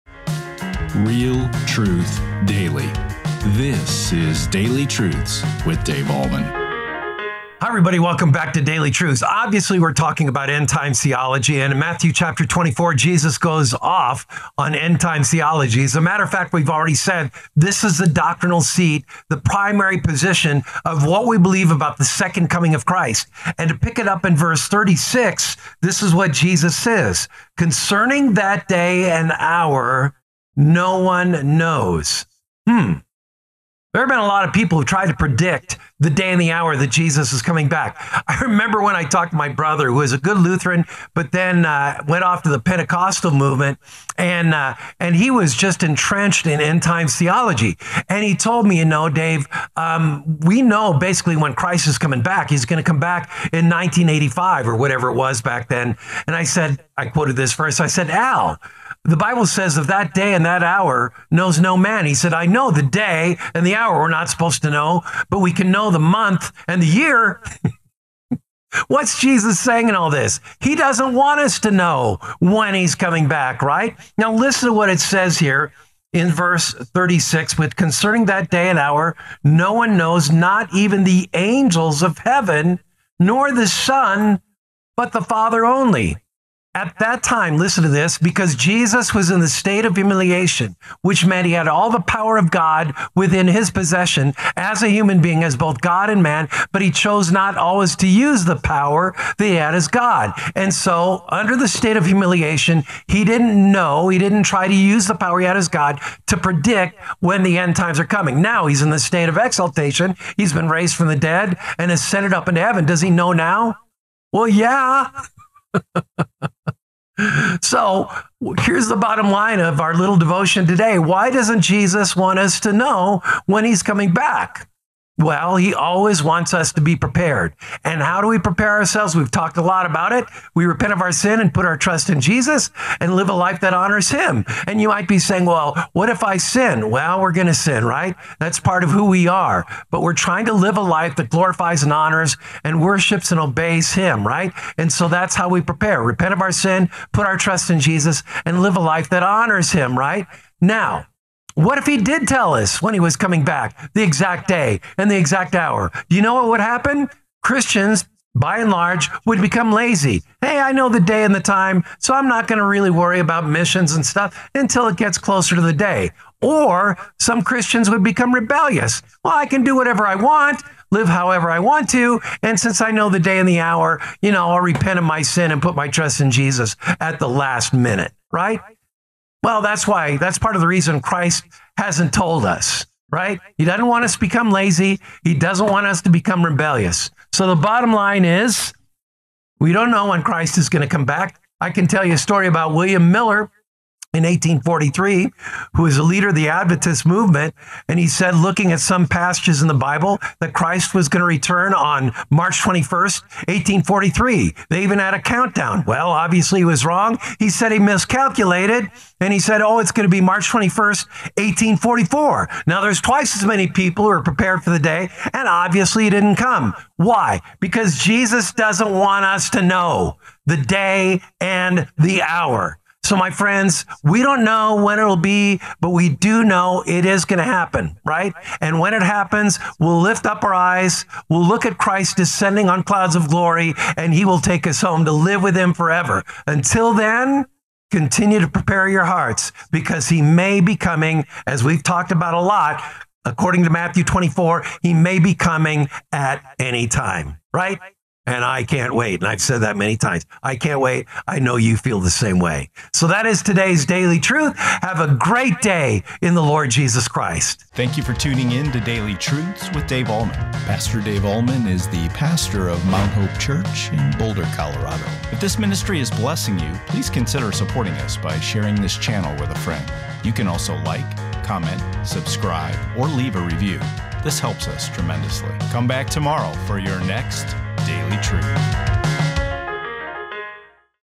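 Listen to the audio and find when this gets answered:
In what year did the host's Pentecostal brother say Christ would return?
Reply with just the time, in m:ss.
0:53.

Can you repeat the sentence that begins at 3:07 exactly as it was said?
So the bottom line is we don't know when Christ is going to come back.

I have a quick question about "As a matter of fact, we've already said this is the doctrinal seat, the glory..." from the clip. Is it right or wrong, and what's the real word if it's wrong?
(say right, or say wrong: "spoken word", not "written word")
wrong: "primary", not "glory".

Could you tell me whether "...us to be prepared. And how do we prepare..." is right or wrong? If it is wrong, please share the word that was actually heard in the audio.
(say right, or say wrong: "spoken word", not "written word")
right.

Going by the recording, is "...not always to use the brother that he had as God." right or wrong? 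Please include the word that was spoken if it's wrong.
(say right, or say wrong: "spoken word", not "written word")
wrong: "power", not "brother".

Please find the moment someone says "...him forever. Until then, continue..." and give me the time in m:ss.
3:55.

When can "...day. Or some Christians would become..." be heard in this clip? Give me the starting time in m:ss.
2:45.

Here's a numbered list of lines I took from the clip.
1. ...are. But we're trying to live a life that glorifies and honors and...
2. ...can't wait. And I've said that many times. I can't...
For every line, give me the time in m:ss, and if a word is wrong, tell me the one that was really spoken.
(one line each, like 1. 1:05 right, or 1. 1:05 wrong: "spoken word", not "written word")
1. 2:19 right
2. 4:08 right.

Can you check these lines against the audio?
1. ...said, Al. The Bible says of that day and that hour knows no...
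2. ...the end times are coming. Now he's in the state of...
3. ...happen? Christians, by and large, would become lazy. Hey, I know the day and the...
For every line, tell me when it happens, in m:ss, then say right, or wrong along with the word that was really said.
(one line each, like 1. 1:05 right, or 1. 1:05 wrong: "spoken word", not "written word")
1. 0:57 right
2. 1:47 right
3. 2:36 right.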